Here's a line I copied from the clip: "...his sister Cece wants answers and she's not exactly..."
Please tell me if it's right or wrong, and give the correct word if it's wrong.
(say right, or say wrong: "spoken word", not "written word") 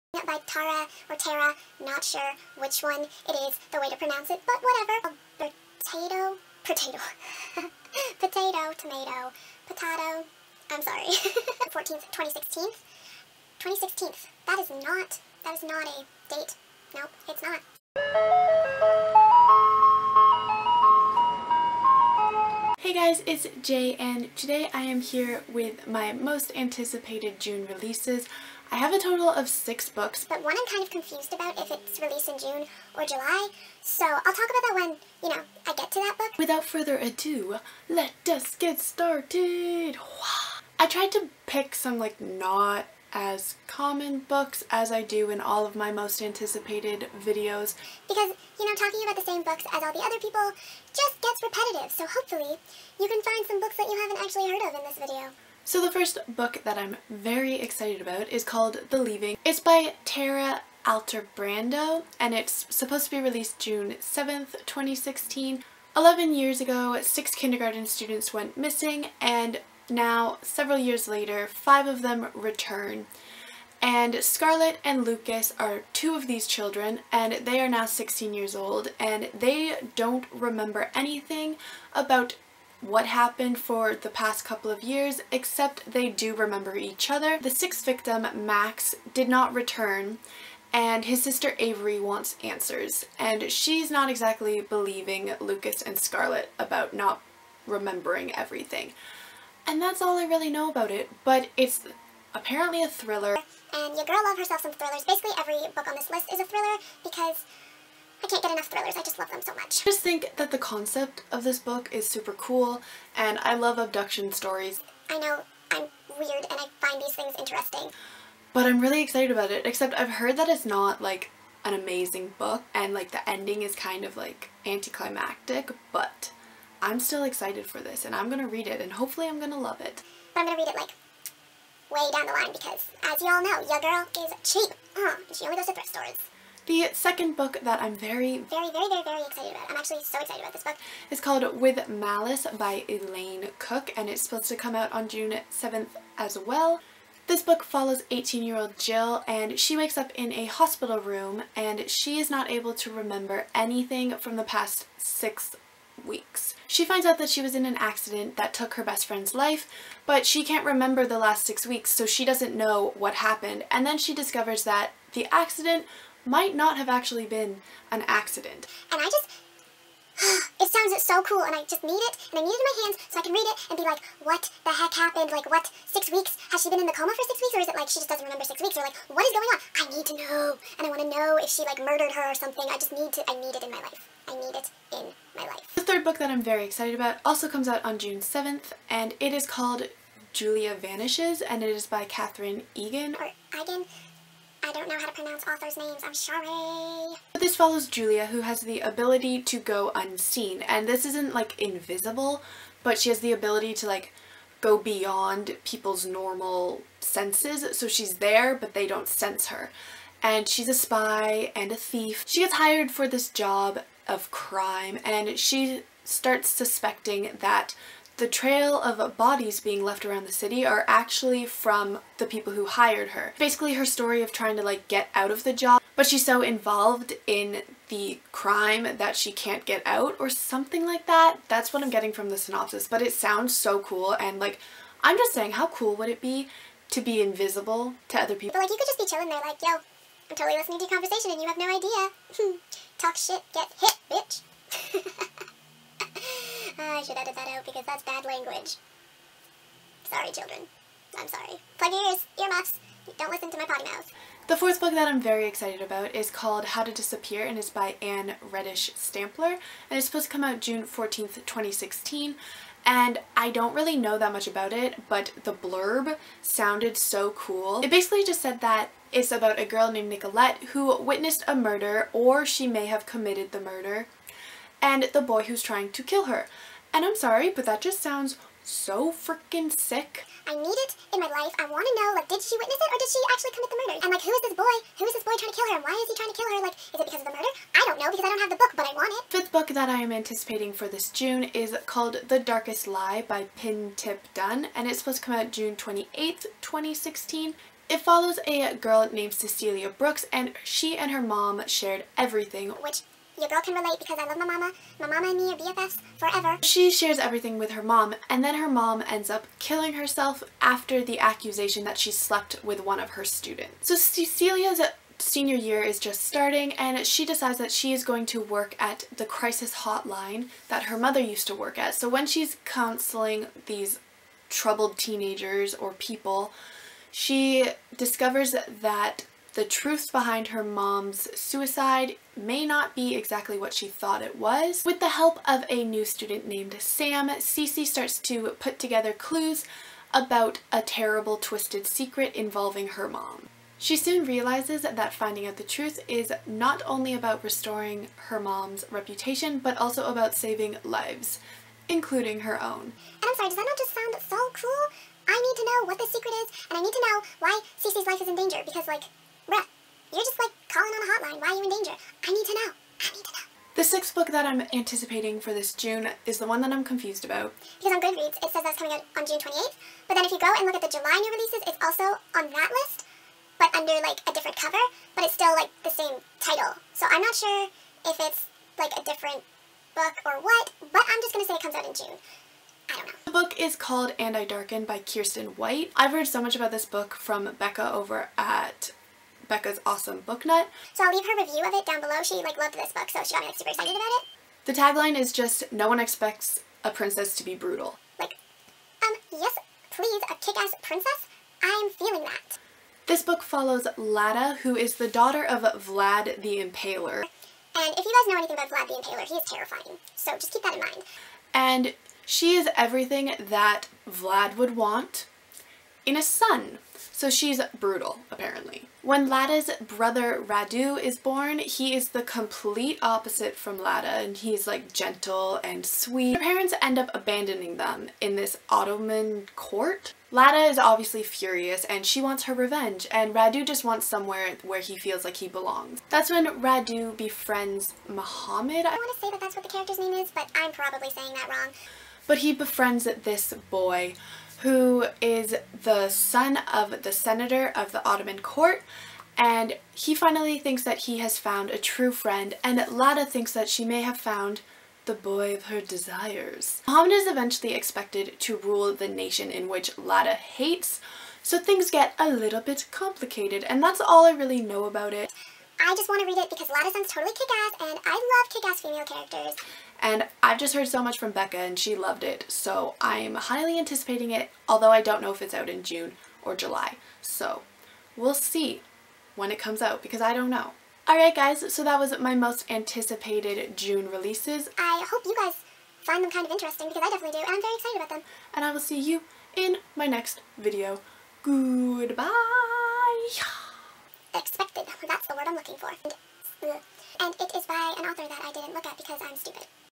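wrong: "Avery", not "Cece".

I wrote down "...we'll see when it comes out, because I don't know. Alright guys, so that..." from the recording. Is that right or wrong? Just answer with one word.
right.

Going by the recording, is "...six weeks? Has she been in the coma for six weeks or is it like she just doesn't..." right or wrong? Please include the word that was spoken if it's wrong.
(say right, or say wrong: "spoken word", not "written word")
right.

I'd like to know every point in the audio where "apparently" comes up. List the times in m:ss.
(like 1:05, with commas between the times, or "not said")
1:42, 6:58.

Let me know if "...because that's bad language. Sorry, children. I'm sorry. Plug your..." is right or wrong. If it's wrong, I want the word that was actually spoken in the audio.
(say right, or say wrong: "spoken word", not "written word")
right.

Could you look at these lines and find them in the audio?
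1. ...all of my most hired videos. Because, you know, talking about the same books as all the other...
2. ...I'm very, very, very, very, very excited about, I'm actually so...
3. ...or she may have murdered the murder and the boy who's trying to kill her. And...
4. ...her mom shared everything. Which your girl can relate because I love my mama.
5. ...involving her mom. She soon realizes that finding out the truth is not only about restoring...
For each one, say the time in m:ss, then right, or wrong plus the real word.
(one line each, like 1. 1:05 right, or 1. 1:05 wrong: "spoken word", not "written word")
1. 0:45 wrong: "anticipated", not "hired"
2. 2:17 right
3. 4:32 wrong: "committed", not "murdered"
4. 5:01 right
5. 5:42 right.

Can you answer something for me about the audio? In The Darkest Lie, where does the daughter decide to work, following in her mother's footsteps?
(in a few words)
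crisis hotline.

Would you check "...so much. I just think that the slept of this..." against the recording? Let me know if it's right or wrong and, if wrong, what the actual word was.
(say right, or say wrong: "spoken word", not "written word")
wrong: "concept", not "slept".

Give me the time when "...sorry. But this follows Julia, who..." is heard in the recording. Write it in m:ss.
3:16.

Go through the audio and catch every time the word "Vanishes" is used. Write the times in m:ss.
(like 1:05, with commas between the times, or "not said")
3:10.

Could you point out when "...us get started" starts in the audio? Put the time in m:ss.
0:38.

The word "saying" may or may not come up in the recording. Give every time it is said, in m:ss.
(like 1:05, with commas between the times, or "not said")
3:55, 7:21.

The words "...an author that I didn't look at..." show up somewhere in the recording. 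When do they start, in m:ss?
8:17.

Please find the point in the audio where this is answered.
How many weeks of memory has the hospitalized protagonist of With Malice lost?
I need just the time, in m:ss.
2:34.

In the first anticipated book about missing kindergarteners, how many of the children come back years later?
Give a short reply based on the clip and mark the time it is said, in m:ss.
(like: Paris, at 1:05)
5, at 1:11.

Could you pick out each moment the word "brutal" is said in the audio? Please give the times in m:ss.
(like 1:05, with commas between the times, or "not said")
6:37, 6:57.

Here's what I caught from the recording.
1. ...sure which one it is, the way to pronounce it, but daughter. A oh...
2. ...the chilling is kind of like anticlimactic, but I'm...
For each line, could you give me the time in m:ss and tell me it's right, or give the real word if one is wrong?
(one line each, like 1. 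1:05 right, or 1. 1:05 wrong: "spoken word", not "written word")
1. 0:02 wrong: "whatever", not "daughter"
2. 2:03 wrong: "ending", not "chilling".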